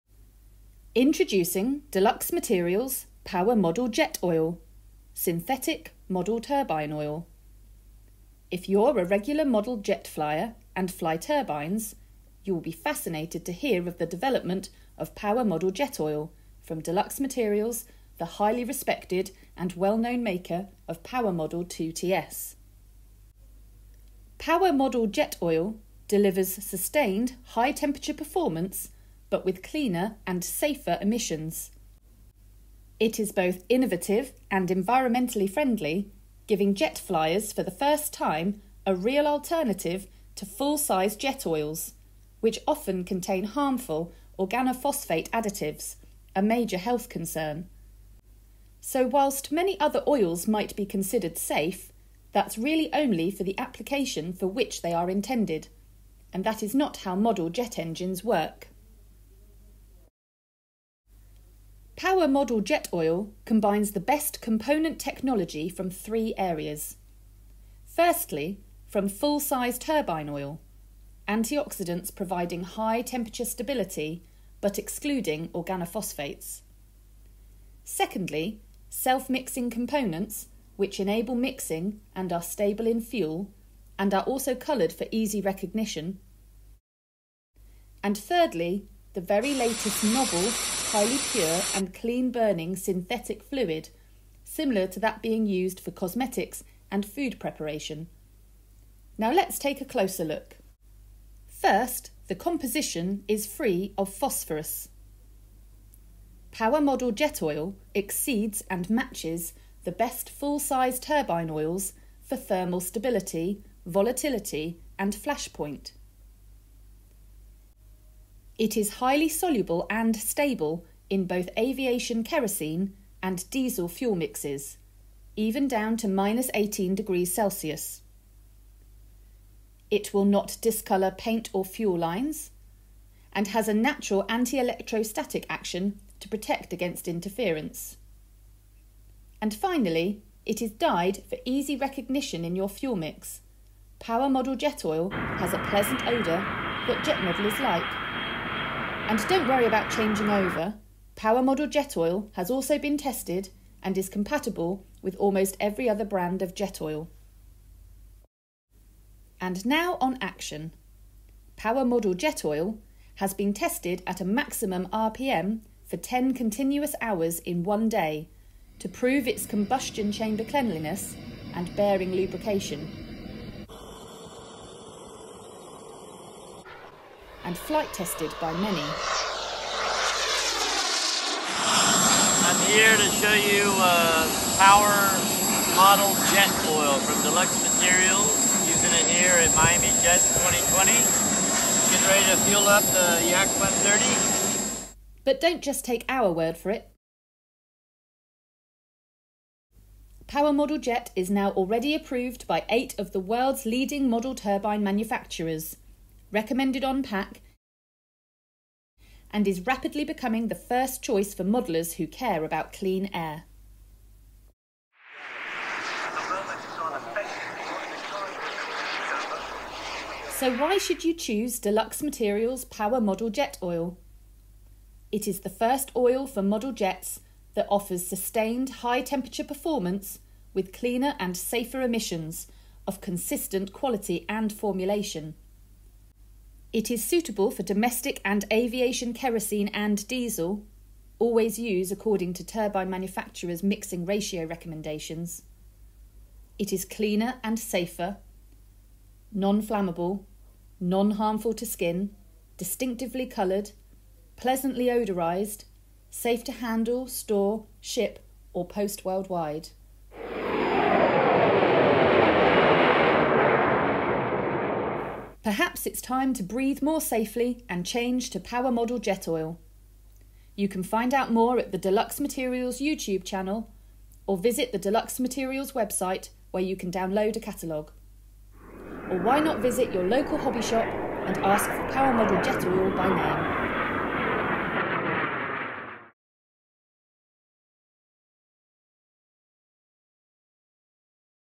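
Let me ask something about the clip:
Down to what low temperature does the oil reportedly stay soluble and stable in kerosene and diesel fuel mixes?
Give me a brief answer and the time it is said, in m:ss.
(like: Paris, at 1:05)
-18 degrees Celsius, at 2:06.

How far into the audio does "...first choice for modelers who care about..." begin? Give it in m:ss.
3:30.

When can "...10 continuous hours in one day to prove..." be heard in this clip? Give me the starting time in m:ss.
2:45.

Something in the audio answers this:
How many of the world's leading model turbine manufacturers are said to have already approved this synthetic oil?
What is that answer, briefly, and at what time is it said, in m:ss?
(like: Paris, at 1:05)
8, at 3:22.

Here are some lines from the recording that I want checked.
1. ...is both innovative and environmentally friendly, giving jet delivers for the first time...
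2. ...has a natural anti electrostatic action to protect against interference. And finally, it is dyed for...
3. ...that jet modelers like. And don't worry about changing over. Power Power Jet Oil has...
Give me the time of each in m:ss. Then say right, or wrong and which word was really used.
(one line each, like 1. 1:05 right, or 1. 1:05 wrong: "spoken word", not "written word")
1. 0:33 wrong: "flyers", not "delivers"
2. 2:13 right
3. 2:26 wrong: "Model", not "Power".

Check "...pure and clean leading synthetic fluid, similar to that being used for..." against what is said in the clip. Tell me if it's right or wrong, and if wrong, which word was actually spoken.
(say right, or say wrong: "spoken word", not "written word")
wrong: "burning", not "leading".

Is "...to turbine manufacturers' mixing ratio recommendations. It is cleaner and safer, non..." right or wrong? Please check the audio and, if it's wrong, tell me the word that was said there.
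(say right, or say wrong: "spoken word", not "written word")
right.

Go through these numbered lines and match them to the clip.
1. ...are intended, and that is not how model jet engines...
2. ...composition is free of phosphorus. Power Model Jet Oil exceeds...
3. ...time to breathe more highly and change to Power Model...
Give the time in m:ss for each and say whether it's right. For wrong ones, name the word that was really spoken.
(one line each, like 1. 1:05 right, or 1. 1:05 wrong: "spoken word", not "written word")
1. 0:54 right
2. 1:42 right
3. 4:26 wrong: "safely", not "highly".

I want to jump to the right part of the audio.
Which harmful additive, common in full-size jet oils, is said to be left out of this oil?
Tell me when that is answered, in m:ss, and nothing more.
0:44.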